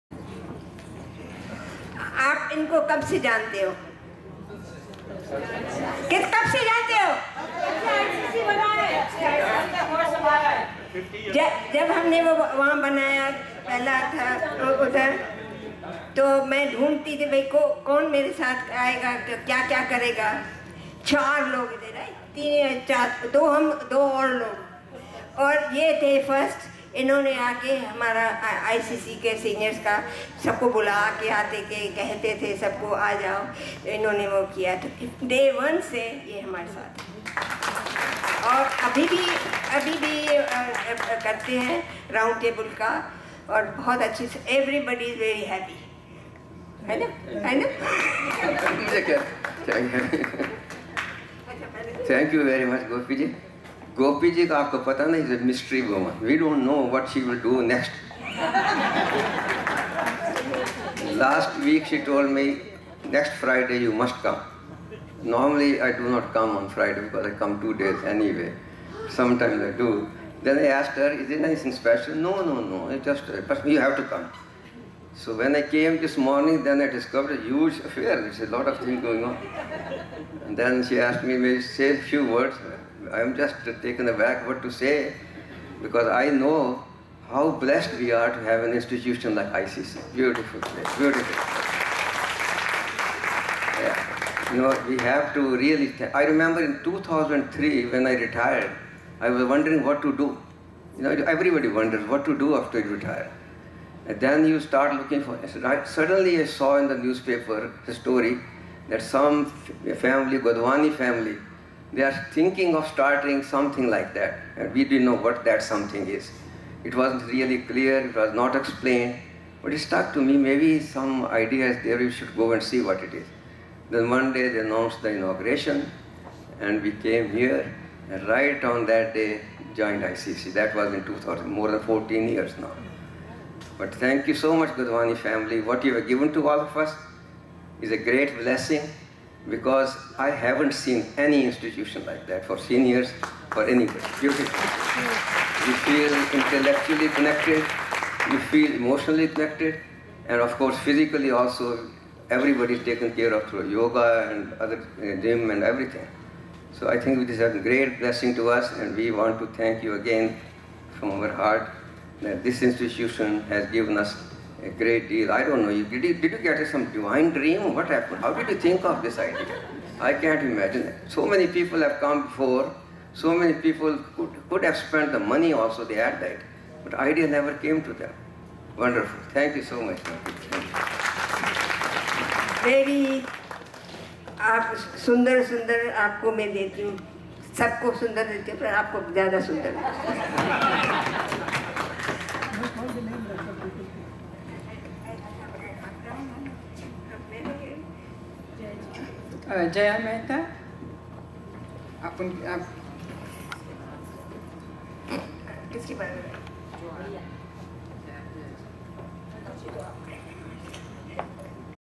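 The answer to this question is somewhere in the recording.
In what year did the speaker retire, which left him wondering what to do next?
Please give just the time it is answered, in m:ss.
1:36.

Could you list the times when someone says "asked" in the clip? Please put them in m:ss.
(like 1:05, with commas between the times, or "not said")
1:10, 1:20.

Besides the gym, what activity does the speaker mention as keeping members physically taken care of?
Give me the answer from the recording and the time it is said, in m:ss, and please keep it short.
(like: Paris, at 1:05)
Yoga, at 2:33.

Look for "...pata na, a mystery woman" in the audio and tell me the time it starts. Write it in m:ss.
0:54.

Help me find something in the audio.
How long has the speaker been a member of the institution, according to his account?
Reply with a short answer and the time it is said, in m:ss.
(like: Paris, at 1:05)
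More than 14 years, at 2:11.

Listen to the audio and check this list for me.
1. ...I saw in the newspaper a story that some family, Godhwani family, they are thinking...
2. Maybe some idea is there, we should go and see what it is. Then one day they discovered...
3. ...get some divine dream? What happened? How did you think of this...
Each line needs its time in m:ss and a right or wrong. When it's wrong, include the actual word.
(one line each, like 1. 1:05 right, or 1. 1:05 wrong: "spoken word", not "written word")
1. 1:46 right
2. 2:00 wrong: "announced", not "discovered"
3. 2:46 right.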